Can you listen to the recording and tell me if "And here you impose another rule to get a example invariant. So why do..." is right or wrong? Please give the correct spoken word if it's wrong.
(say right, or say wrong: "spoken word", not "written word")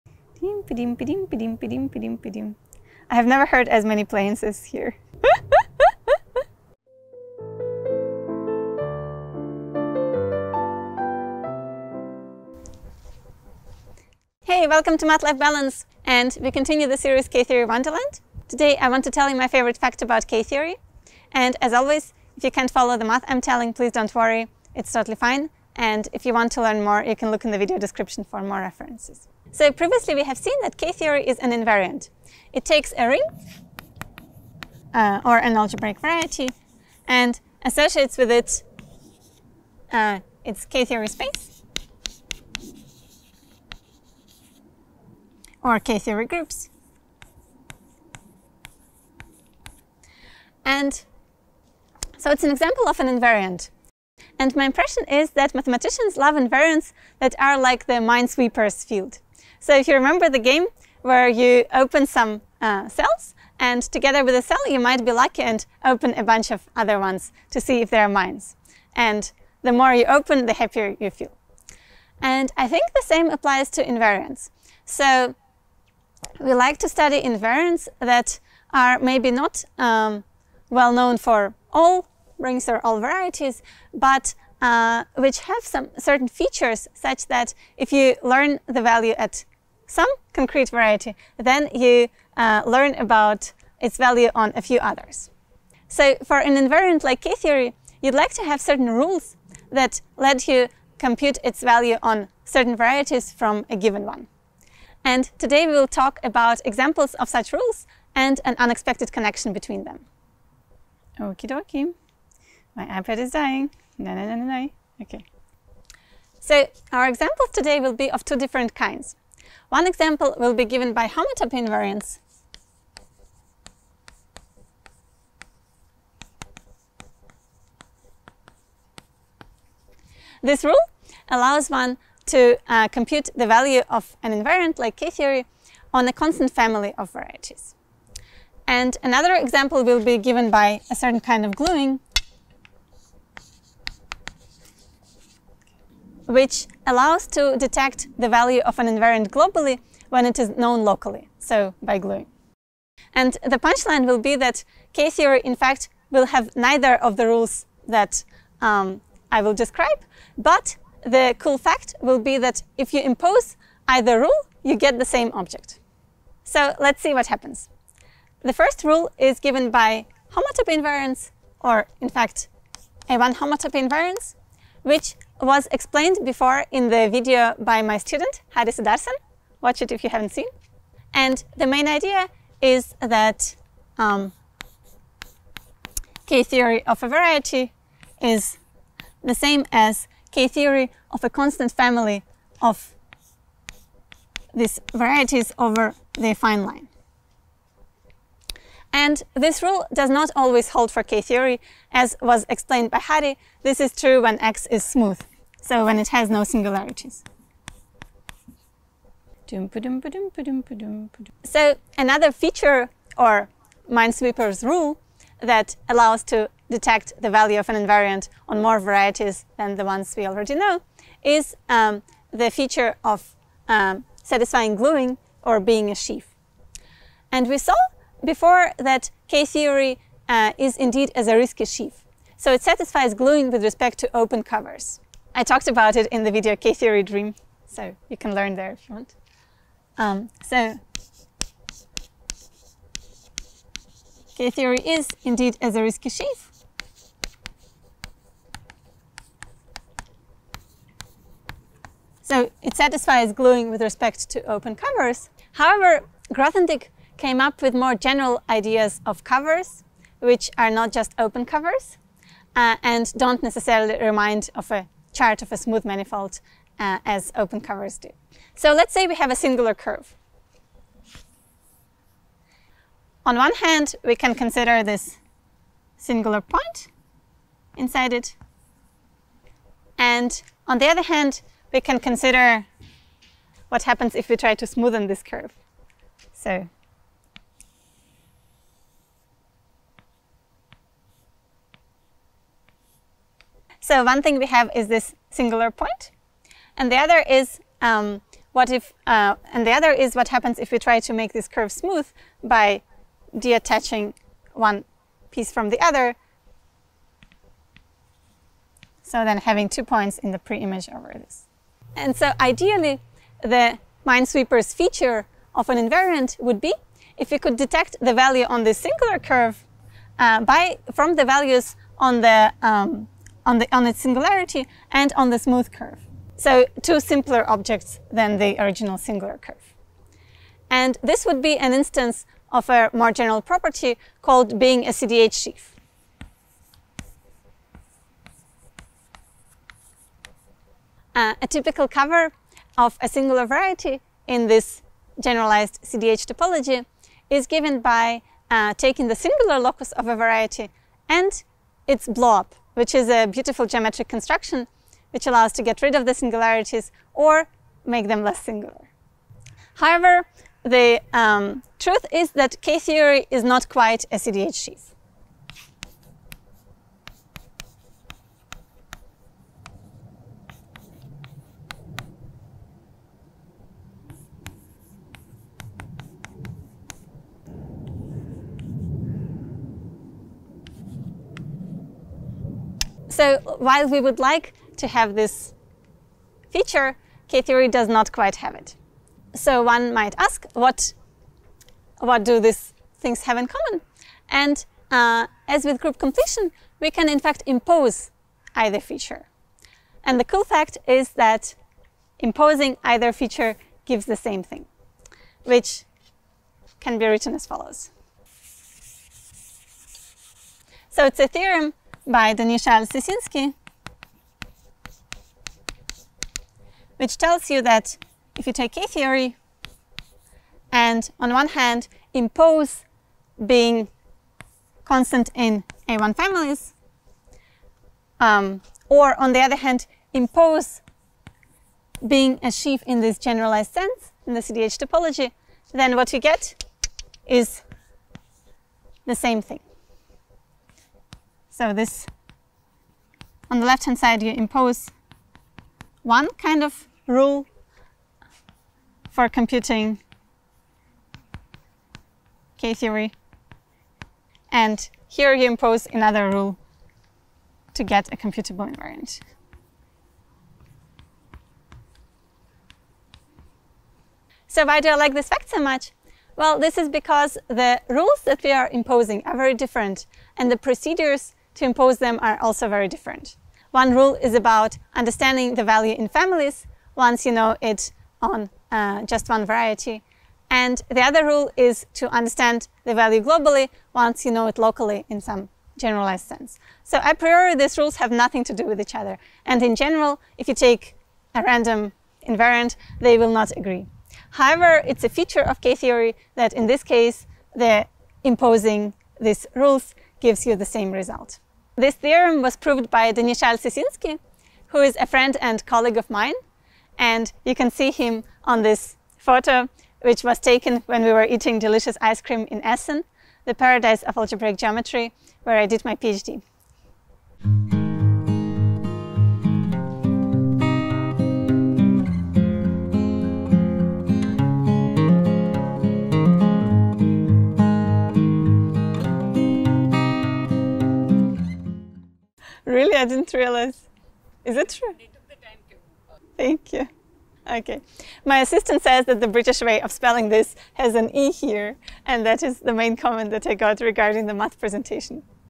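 wrong: "computable", not "example".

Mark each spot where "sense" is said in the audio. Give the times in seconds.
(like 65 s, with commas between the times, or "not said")
433 s, 486 s.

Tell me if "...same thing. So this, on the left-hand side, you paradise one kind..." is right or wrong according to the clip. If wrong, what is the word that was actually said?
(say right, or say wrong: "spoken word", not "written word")
wrong: "impose", not "paradise".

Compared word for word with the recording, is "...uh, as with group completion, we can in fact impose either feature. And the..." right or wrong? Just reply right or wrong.
right.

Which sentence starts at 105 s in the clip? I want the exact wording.
And today we will talk about examples of such rules and an unexpected connection between them.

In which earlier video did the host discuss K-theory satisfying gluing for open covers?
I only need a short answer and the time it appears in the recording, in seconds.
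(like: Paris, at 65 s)
K-theory dream, at 236 s.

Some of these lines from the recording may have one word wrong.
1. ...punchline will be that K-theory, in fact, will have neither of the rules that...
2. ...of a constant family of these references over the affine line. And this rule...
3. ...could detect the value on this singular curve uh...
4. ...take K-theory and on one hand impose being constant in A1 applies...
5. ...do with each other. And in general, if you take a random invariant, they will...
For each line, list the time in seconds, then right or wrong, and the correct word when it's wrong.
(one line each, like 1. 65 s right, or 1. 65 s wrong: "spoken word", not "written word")
1. 153 s right
2. 191 s wrong: "varieties", not "references"
3. 317 s right
4. 418 s wrong: "families", not "applies"
5. 488 s right.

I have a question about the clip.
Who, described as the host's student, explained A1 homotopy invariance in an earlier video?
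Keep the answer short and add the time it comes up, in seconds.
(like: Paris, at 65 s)
Haris Darsan, at 178 s.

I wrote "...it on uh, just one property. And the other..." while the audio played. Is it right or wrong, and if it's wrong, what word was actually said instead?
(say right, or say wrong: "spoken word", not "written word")
wrong: "variety", not "property".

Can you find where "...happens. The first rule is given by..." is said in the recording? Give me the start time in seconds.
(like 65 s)
167 s.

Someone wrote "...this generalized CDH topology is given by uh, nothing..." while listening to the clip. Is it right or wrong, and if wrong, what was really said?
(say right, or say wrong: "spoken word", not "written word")
wrong: "taking", not "nothing".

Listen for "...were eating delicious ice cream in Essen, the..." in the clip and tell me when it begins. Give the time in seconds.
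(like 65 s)
511 s.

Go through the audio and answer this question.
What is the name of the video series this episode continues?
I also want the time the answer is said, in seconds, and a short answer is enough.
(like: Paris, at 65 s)
K-Theory Wonderland, at 17 s.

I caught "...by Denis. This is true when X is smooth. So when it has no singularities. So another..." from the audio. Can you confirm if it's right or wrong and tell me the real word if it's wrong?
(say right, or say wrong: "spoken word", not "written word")
wrong: "Hadi", not "Denis".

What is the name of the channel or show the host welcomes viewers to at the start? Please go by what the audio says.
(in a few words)
Math-life Balance.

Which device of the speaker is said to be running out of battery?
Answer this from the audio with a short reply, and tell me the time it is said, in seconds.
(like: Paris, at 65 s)
iPad, at 112 s.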